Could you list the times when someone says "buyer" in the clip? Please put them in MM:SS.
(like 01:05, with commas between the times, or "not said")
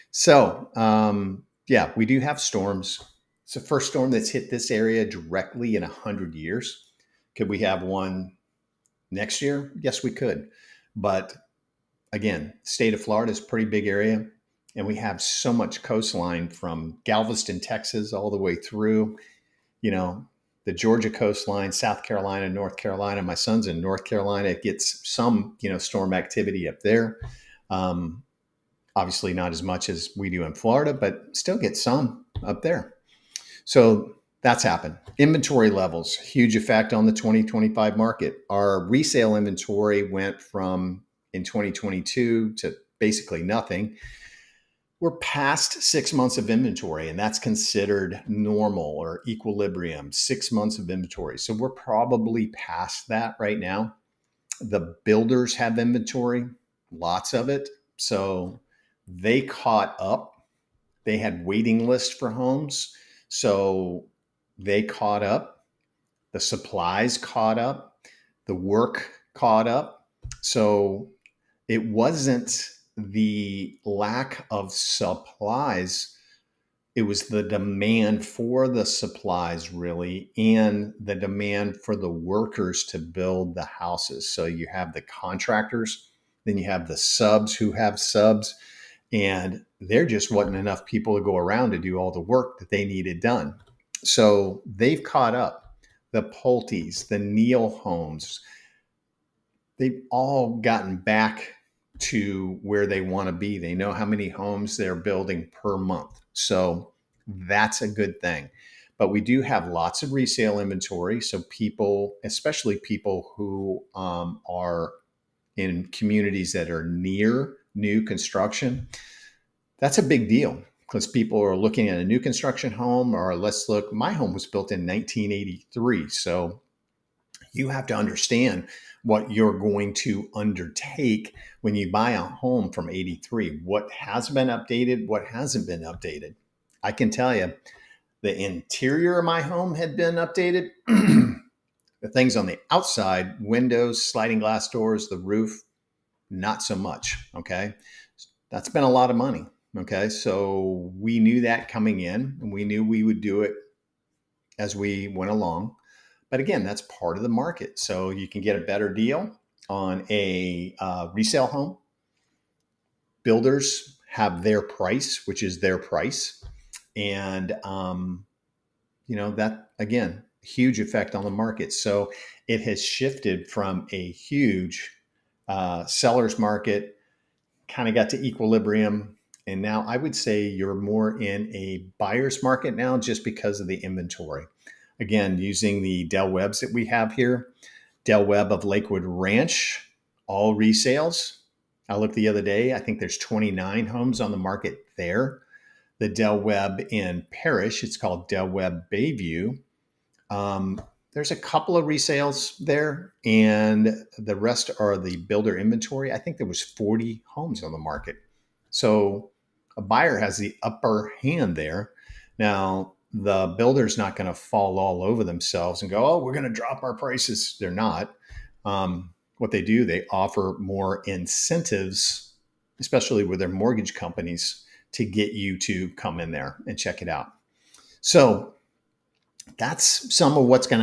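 03:01, 03:29.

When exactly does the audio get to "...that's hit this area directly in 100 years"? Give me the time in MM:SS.
00:04.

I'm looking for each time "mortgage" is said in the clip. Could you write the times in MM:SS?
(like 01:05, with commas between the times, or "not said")
03:43.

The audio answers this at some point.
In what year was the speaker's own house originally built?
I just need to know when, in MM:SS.
02:04.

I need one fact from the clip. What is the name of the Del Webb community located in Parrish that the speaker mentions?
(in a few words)
Del Webb Bayview.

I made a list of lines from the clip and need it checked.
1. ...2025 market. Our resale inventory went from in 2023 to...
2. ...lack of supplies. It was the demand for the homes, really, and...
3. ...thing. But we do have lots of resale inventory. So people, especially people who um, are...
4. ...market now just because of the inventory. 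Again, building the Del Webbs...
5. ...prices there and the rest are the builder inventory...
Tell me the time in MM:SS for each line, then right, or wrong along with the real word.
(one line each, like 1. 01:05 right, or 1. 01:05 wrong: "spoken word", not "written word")
1. 00:37 wrong: "2022", not "2023"
2. 01:13 wrong: "supplies", not "homes"
3. 01:48 right
4. 03:02 wrong: "using", not "building"
5. 03:21 wrong: "resales", not "prices".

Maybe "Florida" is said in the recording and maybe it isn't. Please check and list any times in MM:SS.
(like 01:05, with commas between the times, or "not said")
00:13, 00:30.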